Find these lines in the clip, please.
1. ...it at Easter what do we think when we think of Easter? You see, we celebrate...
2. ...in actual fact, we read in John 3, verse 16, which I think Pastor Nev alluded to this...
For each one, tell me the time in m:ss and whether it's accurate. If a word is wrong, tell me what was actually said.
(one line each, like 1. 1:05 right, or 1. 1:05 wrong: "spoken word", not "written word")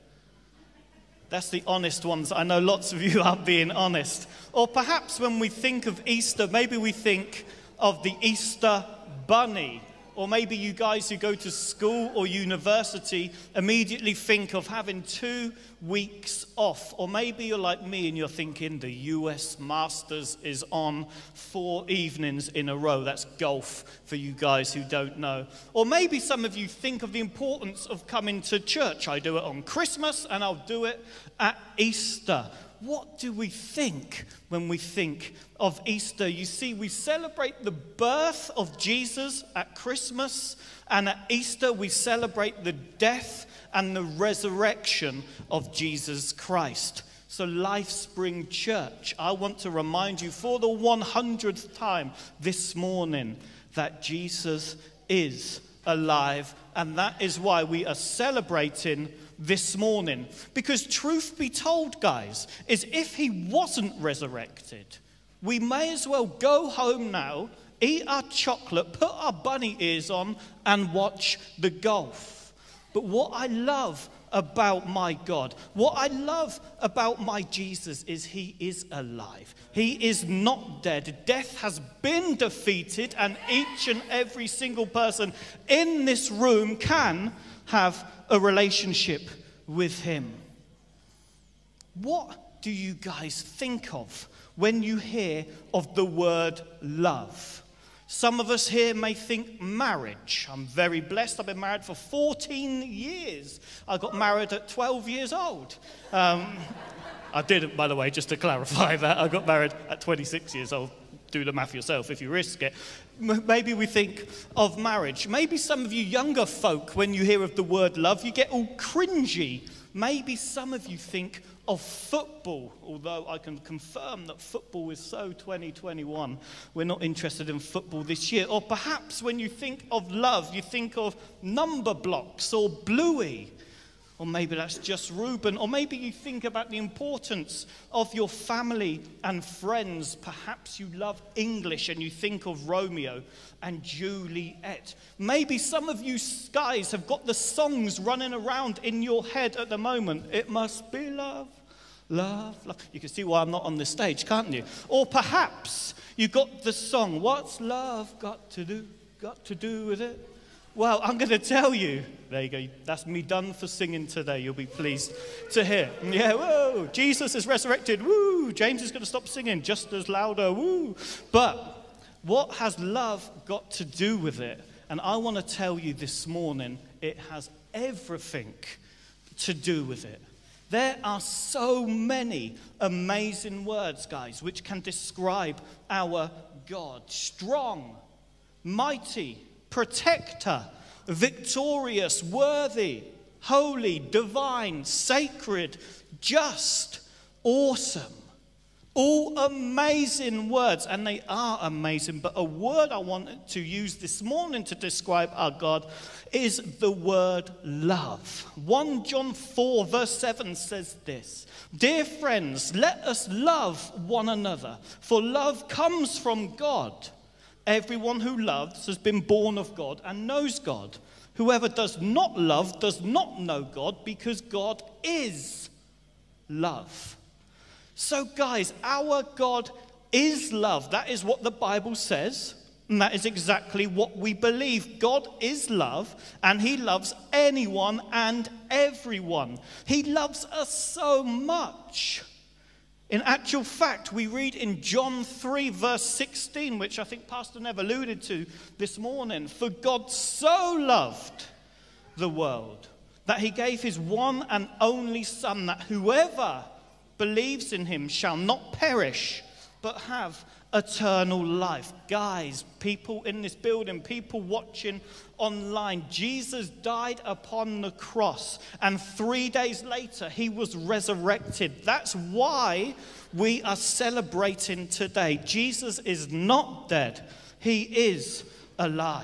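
1. 0:30 right
2. 4:03 right.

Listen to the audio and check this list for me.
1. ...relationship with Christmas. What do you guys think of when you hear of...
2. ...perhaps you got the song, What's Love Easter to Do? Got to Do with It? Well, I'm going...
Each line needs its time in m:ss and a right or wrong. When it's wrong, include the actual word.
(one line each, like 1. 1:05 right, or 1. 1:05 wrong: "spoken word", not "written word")
1. 1:28 wrong: "Him", not "Christmas"
2. 2:35 wrong: "Got", not "Easter".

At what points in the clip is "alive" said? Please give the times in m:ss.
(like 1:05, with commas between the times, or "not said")
0:55, 1:18.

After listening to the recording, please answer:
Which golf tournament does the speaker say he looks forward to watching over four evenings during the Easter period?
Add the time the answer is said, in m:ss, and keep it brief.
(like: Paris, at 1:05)
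US Masters, at 0:18.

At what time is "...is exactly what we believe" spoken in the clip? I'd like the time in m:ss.
3:53.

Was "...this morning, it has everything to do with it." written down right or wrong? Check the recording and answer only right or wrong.
right.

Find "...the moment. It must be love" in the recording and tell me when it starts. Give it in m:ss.
2:29.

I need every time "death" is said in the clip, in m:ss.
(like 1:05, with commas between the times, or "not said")
0:42, 1:21.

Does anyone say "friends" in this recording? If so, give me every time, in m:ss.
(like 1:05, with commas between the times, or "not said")
2:19, 3:32.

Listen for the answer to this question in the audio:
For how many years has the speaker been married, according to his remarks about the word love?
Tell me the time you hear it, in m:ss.
1:41.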